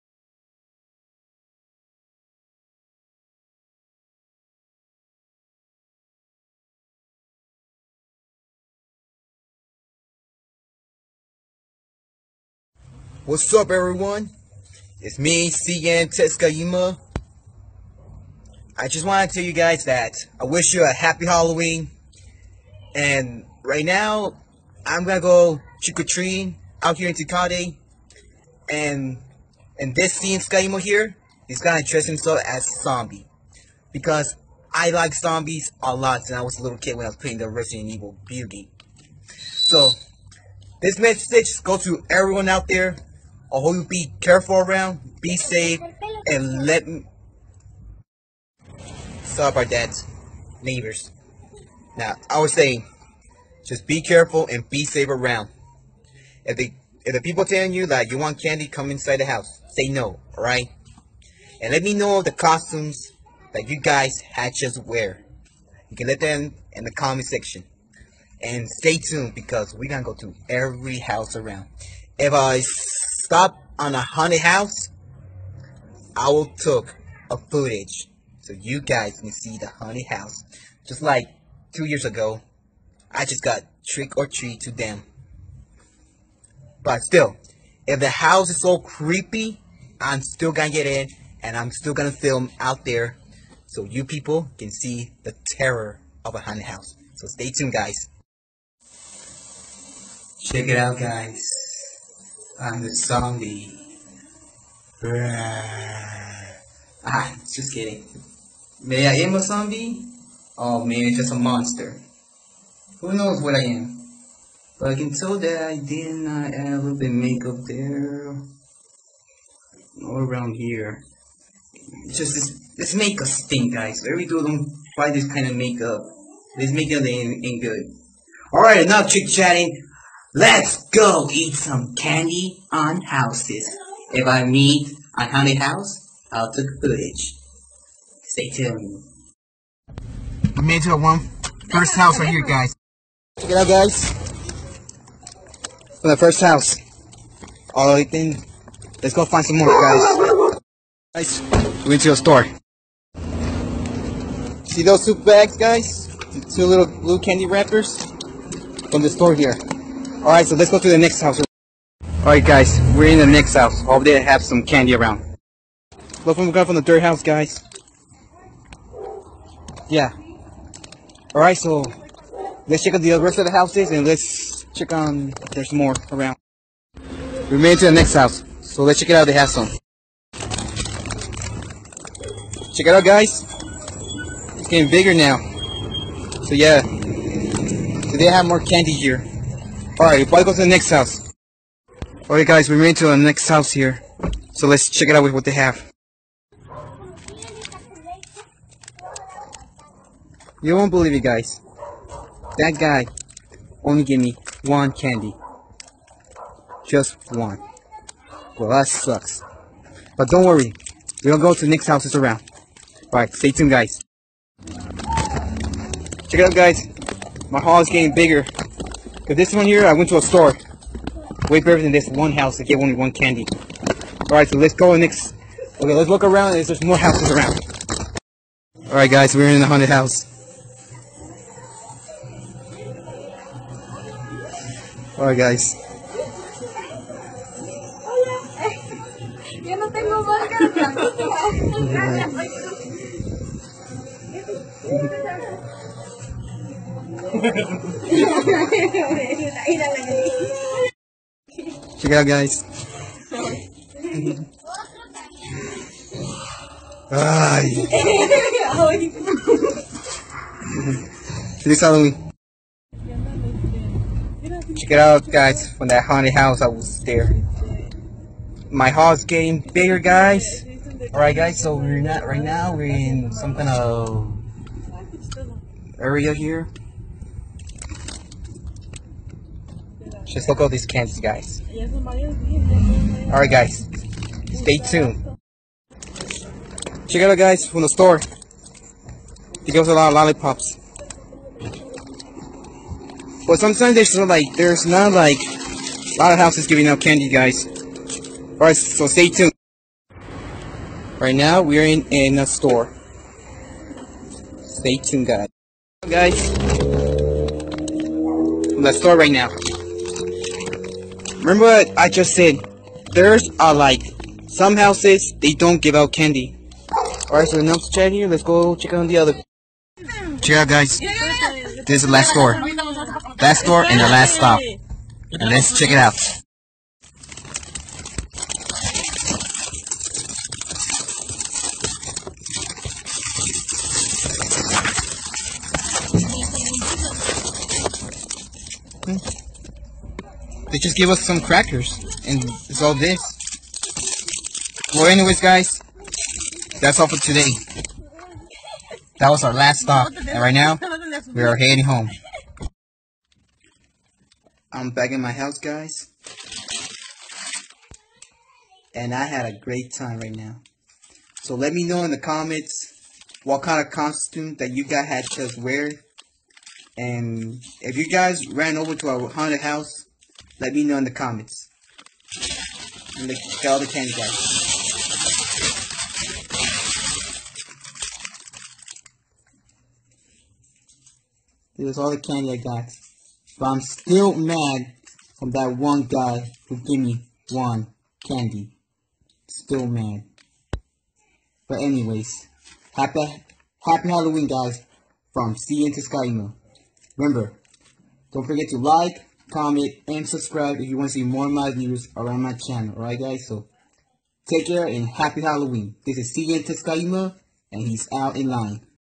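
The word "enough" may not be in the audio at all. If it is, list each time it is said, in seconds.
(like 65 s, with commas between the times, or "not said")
128 s, 317 s.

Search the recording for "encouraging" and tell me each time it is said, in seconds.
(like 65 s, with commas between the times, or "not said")
not said.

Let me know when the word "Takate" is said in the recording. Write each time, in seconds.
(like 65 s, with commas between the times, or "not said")
27 s.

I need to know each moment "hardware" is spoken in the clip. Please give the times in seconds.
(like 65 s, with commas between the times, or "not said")
not said.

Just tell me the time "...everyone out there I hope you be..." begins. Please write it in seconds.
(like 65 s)
42 s.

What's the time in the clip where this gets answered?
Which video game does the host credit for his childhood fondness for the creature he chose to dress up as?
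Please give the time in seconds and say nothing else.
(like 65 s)
37 s.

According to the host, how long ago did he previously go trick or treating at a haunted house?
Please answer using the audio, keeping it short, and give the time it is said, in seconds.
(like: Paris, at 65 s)
two years ago, at 81 s.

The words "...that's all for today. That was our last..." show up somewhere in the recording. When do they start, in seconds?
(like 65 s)
346 s.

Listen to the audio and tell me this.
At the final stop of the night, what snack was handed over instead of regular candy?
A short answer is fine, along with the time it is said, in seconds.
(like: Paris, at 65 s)
crackers, at 341 s.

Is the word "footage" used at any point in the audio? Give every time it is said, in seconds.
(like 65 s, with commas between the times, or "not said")
77 s, 136 s.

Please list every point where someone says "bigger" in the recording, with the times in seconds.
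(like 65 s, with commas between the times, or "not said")
184 s, 218 s, 269 s.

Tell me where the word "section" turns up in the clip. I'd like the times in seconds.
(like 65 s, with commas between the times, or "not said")
67 s.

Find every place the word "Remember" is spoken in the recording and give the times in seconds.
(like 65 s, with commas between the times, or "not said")
311 s, 397 s.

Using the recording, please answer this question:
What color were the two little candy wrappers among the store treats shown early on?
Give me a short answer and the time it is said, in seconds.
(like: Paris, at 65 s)
blue, at 156 s.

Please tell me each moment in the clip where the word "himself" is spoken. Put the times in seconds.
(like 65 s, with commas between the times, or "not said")
32 s.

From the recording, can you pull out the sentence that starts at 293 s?
But sometimes there's like, there's not like, a lot of houses giving out candy, guys.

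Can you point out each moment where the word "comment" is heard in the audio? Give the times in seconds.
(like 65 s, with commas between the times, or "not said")
66 s, 362 s, 371 s, 399 s.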